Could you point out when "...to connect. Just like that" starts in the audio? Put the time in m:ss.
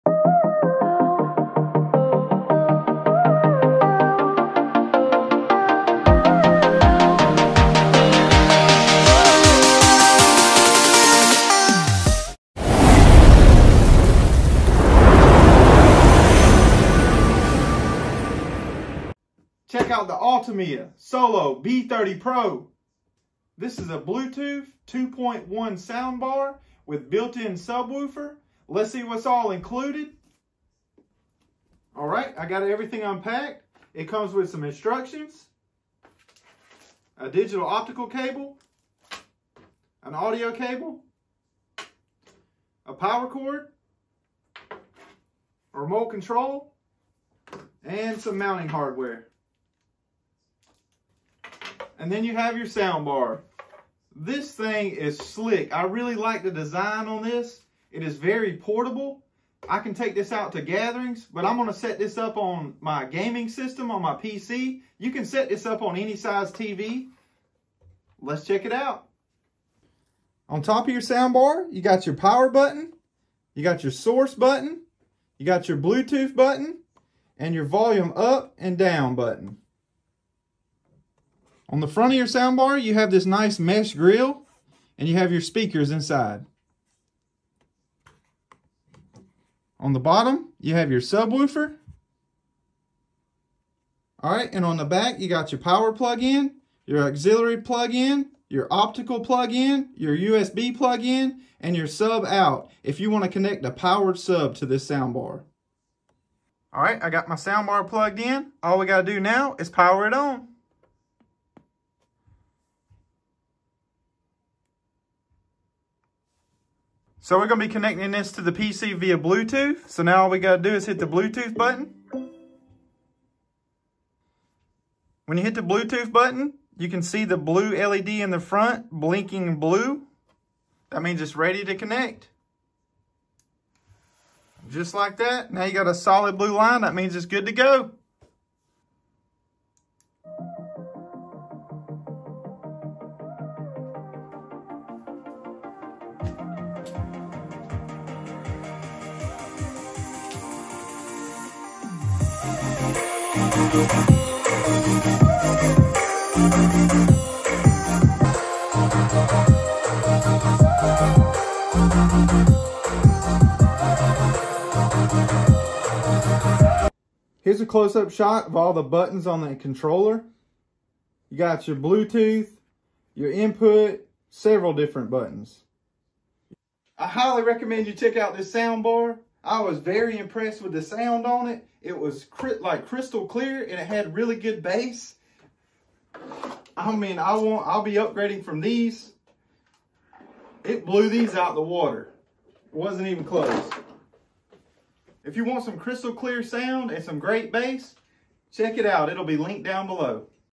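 2:11.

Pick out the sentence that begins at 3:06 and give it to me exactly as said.
I mean, I won't, I'll be upgrading from these.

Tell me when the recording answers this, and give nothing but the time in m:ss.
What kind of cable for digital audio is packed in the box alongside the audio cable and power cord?
0:37.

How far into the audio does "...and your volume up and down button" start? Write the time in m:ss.
1:17.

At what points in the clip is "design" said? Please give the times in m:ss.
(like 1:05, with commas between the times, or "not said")
0:56.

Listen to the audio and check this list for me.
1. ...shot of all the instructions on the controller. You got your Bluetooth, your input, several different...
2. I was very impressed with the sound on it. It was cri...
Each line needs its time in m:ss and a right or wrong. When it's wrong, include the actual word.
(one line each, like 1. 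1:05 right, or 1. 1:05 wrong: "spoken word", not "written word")
1. 2:48 wrong: "buttons", not "instructions"
2. 2:59 right.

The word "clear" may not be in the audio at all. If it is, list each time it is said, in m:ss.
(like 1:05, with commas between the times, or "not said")
3:03, 3:16.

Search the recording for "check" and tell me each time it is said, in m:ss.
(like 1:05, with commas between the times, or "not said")
0:19, 1:08, 2:57, 3:18.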